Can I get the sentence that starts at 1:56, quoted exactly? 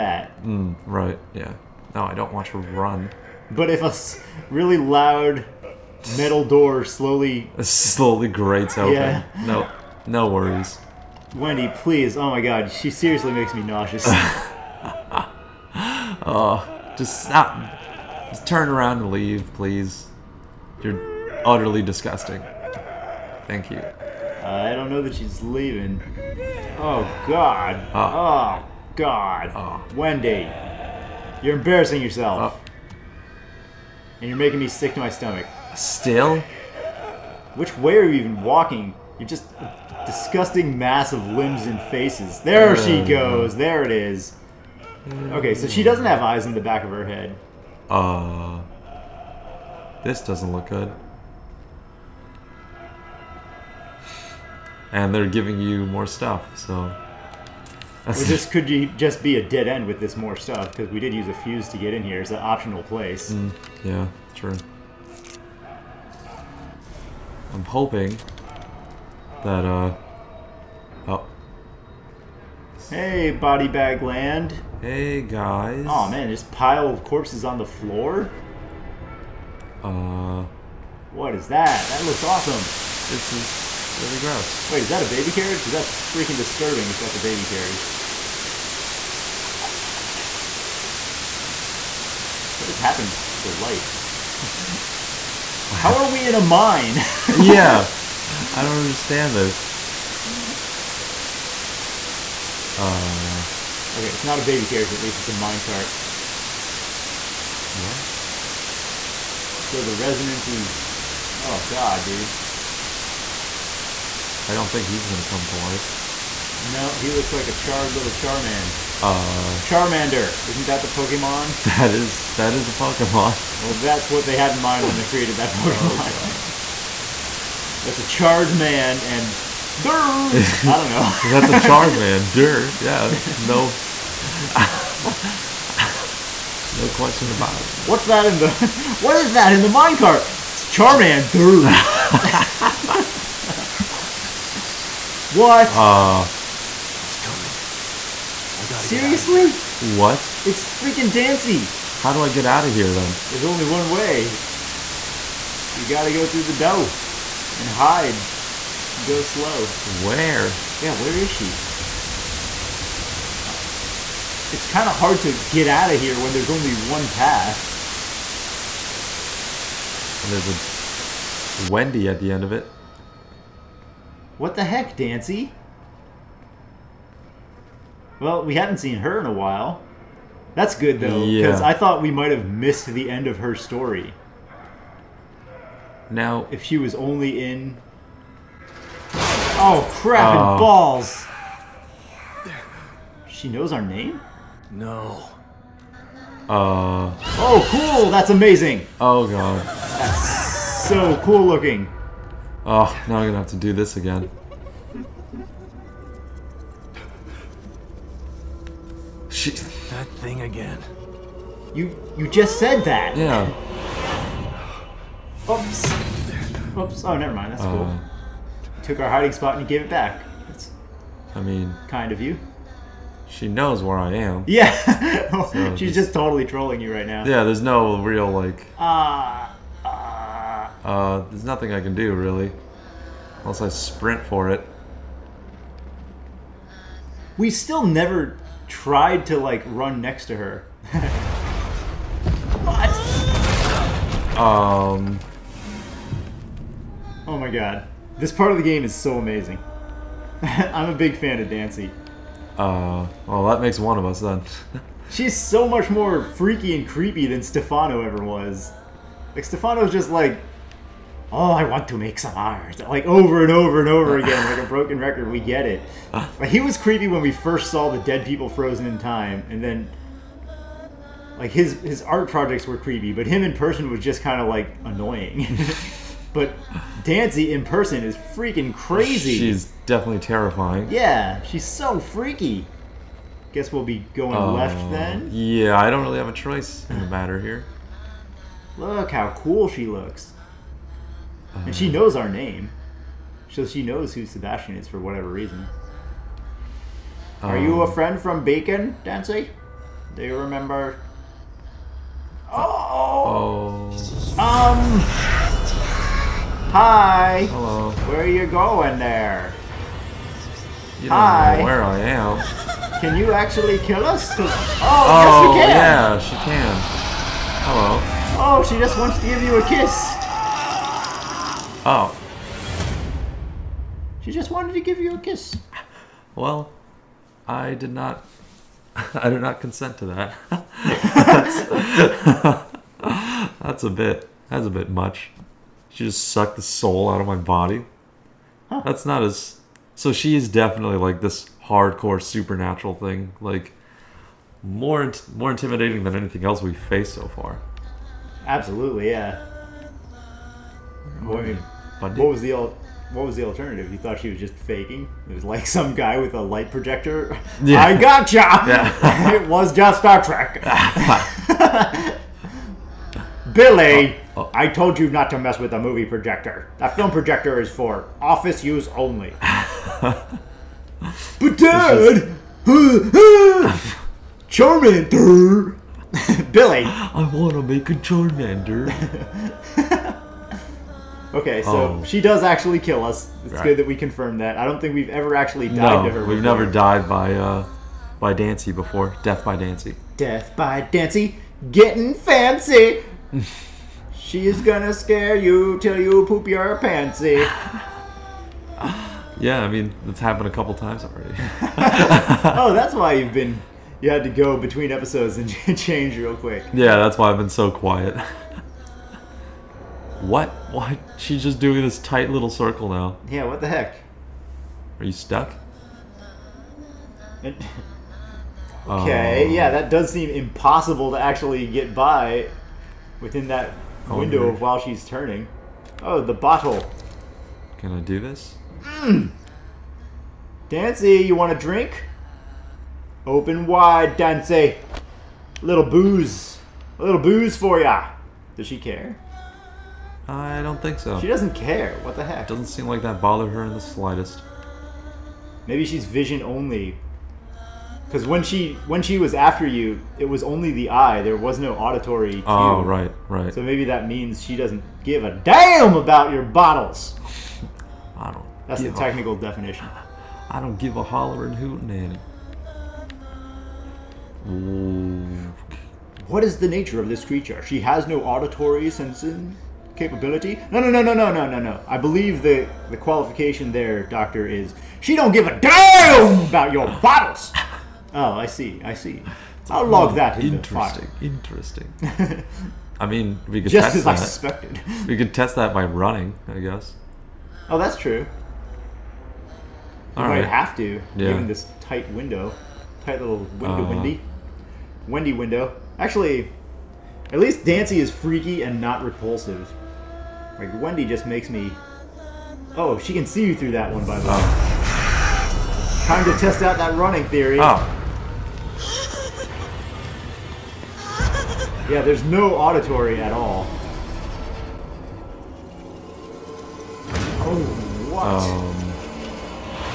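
No, he looks like a charred little Charman.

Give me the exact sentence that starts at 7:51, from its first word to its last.
I believe the the qualification there, doctor, is she don't give a damn about your bottles.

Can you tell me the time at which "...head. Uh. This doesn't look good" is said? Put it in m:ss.
0:47.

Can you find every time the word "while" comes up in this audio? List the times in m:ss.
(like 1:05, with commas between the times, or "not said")
2:59, 7:04.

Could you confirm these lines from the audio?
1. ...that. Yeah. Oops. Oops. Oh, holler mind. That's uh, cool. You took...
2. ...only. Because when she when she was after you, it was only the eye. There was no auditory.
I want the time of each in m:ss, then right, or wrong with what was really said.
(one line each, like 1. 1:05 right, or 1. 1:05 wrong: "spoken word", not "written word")
1. 3:32 wrong: "never", not "holler"
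2. 7:26 right.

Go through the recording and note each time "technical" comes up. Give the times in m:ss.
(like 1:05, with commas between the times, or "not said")
7:38.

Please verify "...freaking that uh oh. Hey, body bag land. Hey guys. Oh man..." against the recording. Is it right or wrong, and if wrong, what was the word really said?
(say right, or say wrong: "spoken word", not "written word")
wrong: "hoping", not "freaking".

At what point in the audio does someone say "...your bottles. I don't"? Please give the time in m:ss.
7:36.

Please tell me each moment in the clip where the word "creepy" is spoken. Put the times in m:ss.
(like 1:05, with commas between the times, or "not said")
4:16, 4:26, 4:32.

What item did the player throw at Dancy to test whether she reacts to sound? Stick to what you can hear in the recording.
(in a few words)
the bottle.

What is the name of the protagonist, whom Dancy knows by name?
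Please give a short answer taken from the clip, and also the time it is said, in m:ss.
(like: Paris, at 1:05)
Sebastian, at 4:54.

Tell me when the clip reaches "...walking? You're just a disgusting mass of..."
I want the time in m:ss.
0:38.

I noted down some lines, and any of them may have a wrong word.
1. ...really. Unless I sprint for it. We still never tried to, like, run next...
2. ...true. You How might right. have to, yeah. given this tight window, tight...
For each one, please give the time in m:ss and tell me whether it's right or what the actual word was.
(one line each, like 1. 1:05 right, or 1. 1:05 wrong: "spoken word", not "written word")
1. 3:52 right
2. 8:07 wrong: "All", not "How".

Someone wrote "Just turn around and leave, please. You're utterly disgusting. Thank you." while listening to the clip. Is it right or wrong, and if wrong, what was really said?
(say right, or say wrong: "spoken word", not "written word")
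right.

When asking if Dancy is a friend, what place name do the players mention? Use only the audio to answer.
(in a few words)
Beacon.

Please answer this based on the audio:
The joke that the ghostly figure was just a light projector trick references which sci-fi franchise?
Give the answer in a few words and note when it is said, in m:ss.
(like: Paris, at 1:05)
Star Trek, at 5:59.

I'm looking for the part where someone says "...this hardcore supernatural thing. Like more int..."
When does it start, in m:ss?
5:41.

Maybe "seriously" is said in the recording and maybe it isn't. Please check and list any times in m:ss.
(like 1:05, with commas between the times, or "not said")
0:12, 2:28.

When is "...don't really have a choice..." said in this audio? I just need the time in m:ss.
4:45.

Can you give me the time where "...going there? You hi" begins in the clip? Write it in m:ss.
5:08.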